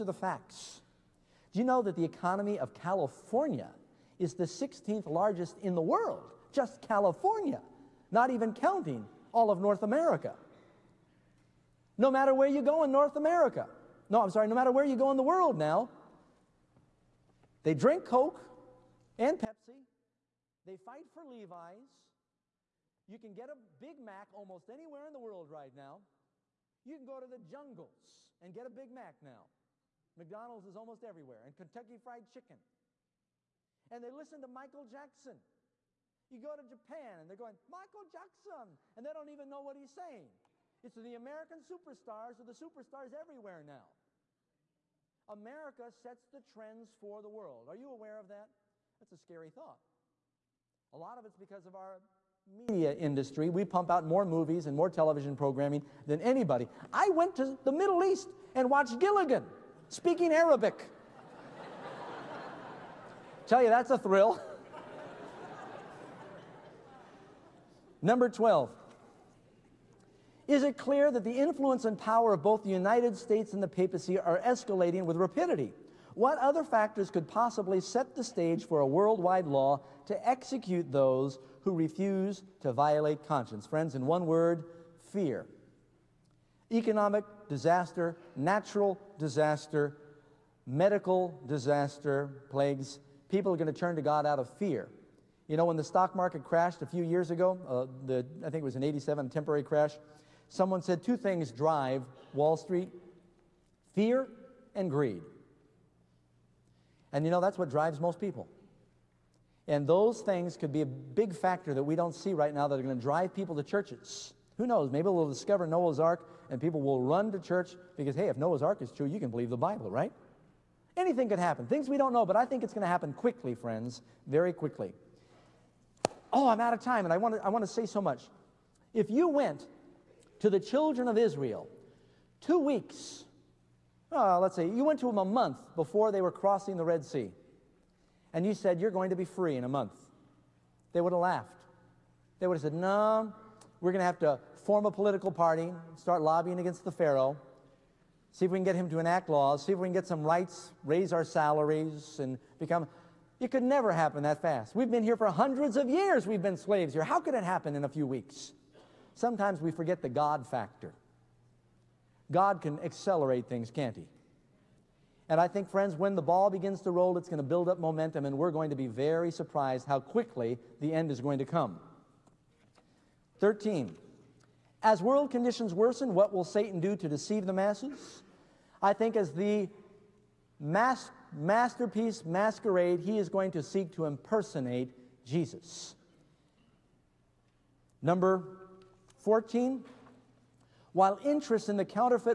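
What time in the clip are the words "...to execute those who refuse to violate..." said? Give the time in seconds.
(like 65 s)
80 s.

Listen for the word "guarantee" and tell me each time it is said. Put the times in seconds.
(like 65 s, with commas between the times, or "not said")
not said.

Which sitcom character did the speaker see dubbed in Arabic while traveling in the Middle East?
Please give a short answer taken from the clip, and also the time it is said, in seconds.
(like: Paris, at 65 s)
Gilligan, at 58 s.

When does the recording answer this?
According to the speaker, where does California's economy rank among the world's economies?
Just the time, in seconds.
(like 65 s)
4 s.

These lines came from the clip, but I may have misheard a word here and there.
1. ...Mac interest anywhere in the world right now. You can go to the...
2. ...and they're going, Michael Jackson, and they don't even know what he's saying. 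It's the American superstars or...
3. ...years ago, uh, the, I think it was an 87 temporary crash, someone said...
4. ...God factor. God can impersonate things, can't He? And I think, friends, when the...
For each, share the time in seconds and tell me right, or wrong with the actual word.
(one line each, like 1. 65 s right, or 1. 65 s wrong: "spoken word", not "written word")
1. 23 s wrong: "almost", not "interest"
2. 37 s right
3. 97 s right
4. 160 s wrong: "accelerate", not "impersonate".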